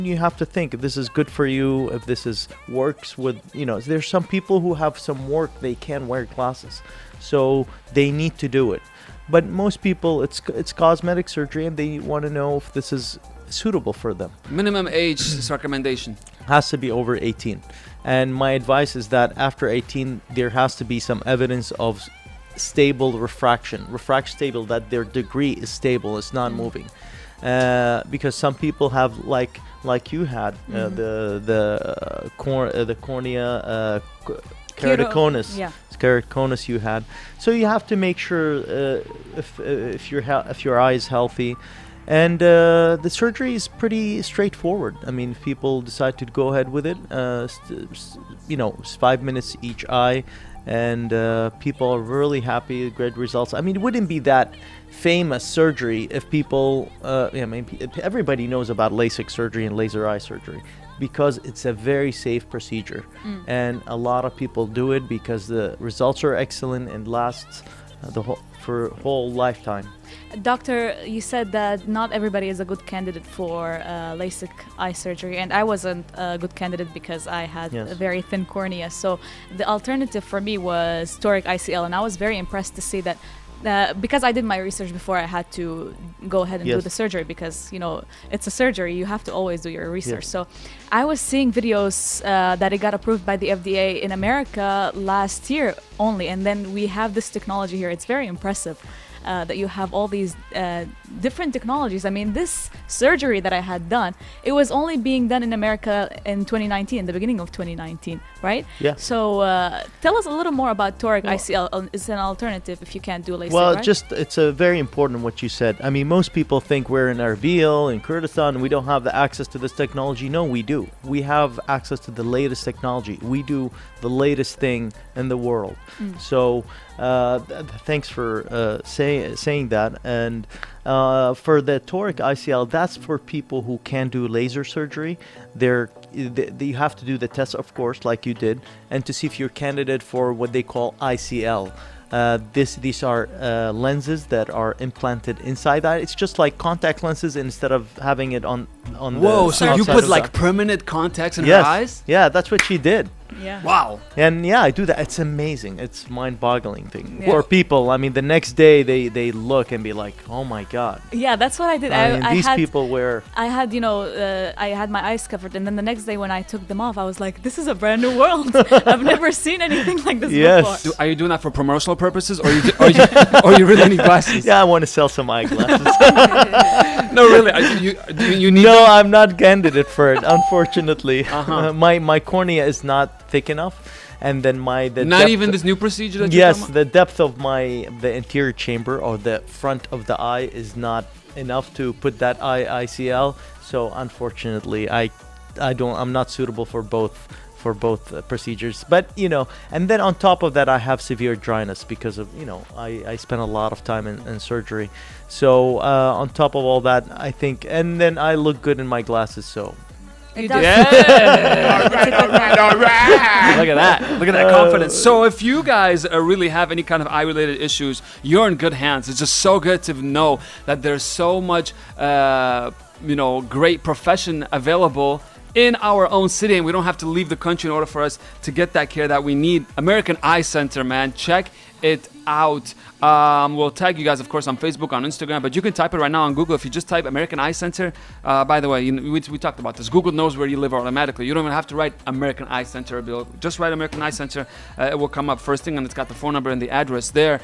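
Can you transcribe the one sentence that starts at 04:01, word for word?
You don't even have to write American Eye Center.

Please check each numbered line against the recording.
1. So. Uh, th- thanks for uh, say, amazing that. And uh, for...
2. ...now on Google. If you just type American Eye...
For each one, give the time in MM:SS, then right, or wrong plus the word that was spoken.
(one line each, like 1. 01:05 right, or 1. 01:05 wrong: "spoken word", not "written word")
1. 02:06 wrong: "saying", not "amazing"
2. 03:56 right.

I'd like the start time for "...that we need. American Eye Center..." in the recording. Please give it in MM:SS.
03:49.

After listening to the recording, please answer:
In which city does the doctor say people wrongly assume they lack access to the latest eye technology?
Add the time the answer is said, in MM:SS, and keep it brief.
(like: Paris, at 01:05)
Erbil, at 01:57.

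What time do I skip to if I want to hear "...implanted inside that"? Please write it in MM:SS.
02:24.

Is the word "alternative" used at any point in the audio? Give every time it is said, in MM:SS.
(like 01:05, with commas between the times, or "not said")
01:19, 01:52.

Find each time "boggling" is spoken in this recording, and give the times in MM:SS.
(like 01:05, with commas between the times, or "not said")
02:36.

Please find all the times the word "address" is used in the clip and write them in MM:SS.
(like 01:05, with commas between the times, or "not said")
04:06.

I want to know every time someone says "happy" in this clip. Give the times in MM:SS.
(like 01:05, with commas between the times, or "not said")
00:52.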